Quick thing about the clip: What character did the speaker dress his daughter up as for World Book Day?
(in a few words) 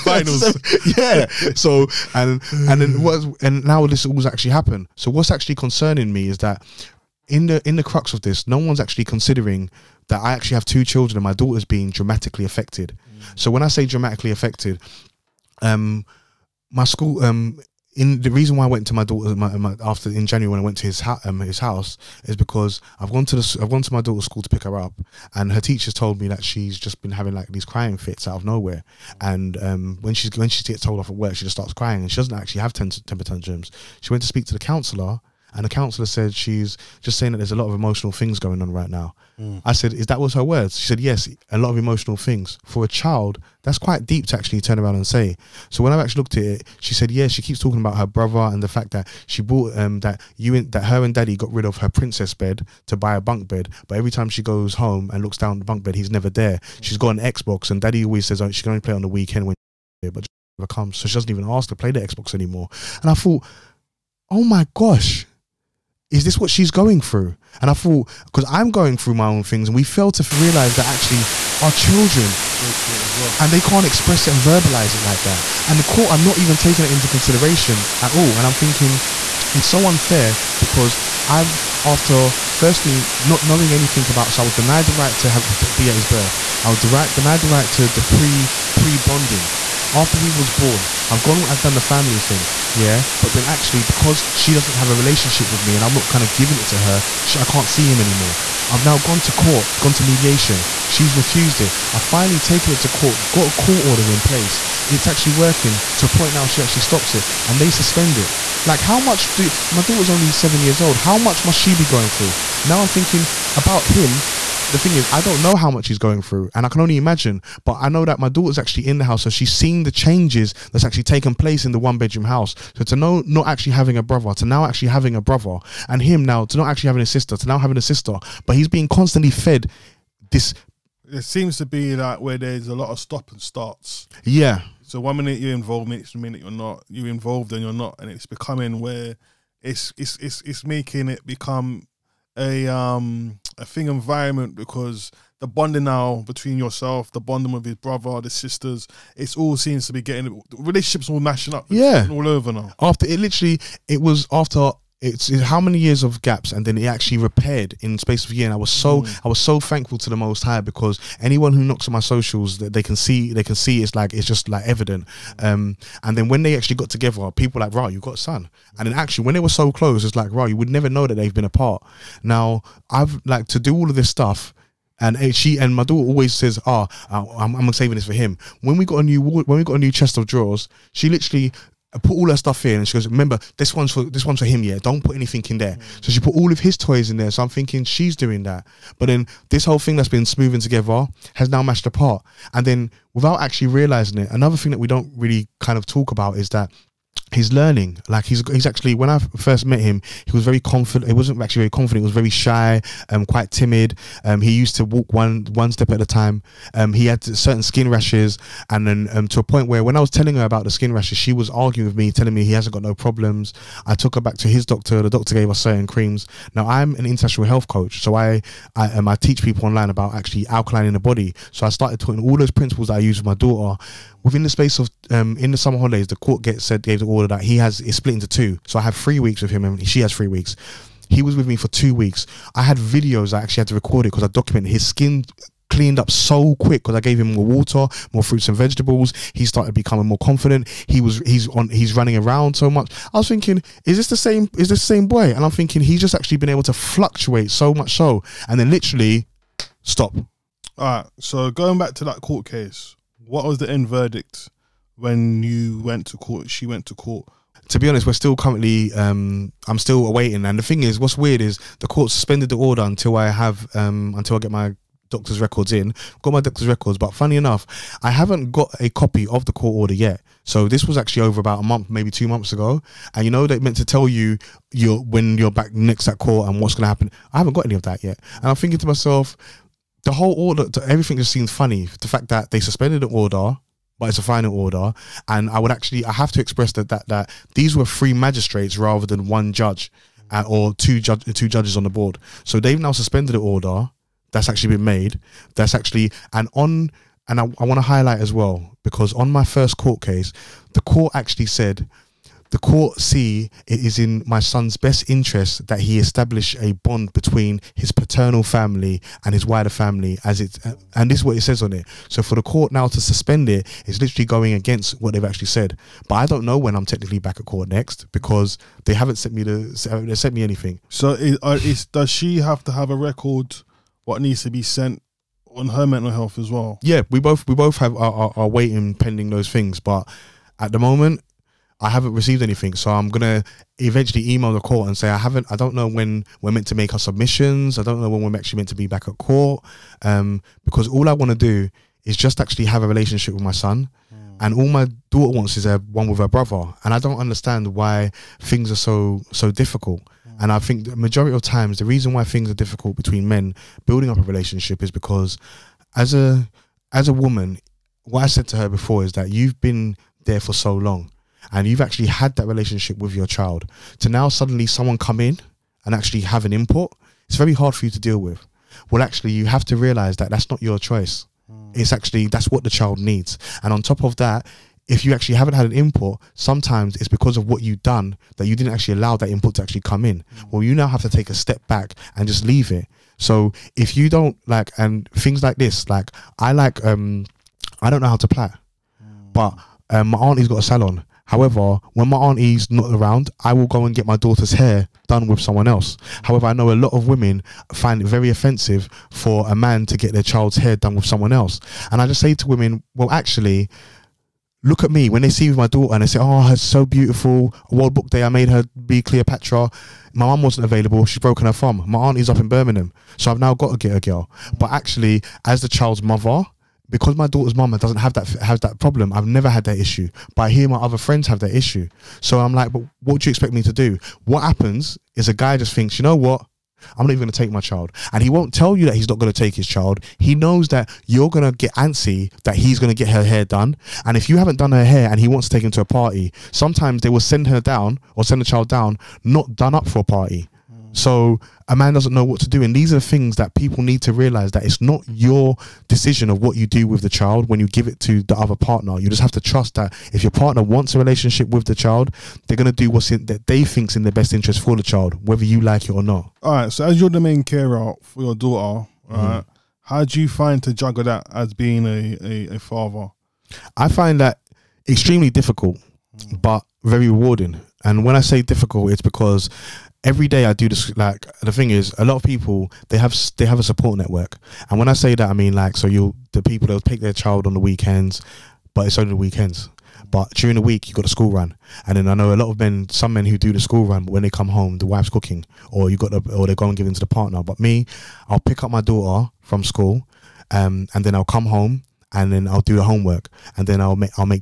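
Cleopatra.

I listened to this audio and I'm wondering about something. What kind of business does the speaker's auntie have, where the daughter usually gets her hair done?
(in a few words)
a salon.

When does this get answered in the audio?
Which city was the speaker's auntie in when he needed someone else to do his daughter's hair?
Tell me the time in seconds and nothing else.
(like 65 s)
412 s.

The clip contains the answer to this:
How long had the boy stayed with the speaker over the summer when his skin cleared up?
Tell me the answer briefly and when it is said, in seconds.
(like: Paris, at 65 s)
2 weeks, at 231 s.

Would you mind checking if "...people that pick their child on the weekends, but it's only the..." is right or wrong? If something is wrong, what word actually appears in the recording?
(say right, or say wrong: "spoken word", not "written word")
right.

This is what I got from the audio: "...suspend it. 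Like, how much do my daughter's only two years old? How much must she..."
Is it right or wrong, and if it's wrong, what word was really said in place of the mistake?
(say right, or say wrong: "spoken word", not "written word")
wrong: "seven", not "two".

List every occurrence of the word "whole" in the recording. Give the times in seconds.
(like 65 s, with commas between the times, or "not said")
189 s, 280 s.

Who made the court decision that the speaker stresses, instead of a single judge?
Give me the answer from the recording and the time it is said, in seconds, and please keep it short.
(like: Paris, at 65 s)
three magistrates, at 287 s.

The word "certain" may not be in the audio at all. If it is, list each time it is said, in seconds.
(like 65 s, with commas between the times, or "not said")
207 s, 215 s.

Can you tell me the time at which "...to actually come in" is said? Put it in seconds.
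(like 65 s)
379 s.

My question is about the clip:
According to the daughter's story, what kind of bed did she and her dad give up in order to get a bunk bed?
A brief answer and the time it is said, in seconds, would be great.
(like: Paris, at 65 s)
princess bed, at 51 s.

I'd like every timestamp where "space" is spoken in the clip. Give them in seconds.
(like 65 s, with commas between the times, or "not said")
157 s, 224 s.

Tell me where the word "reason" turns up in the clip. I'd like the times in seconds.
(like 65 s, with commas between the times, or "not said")
18 s, 351 s.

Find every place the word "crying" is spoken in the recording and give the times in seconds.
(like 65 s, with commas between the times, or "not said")
27 s, 31 s.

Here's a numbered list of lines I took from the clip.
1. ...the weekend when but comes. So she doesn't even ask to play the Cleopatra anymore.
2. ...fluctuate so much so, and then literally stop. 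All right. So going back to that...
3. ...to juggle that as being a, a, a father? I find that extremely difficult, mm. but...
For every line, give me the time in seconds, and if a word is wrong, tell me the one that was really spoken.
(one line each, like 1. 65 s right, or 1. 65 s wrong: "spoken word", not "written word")
1. 59 s wrong: "Xbox", not "Cleopatra"
2. 246 s right
3. 460 s right.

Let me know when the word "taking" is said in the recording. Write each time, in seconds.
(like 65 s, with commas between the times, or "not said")
76 s.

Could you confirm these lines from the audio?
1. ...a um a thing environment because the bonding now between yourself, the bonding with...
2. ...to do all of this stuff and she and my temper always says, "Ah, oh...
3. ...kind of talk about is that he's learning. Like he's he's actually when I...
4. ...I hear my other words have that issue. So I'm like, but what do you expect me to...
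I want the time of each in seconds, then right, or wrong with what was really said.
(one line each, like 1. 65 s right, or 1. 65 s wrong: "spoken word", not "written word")
1. 142 s right
2. 173 s wrong: "daughter", not "temper"
3. 195 s right
4. 420 s wrong: "friends", not "words".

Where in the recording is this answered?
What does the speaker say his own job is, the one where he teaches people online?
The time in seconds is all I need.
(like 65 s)
217 s.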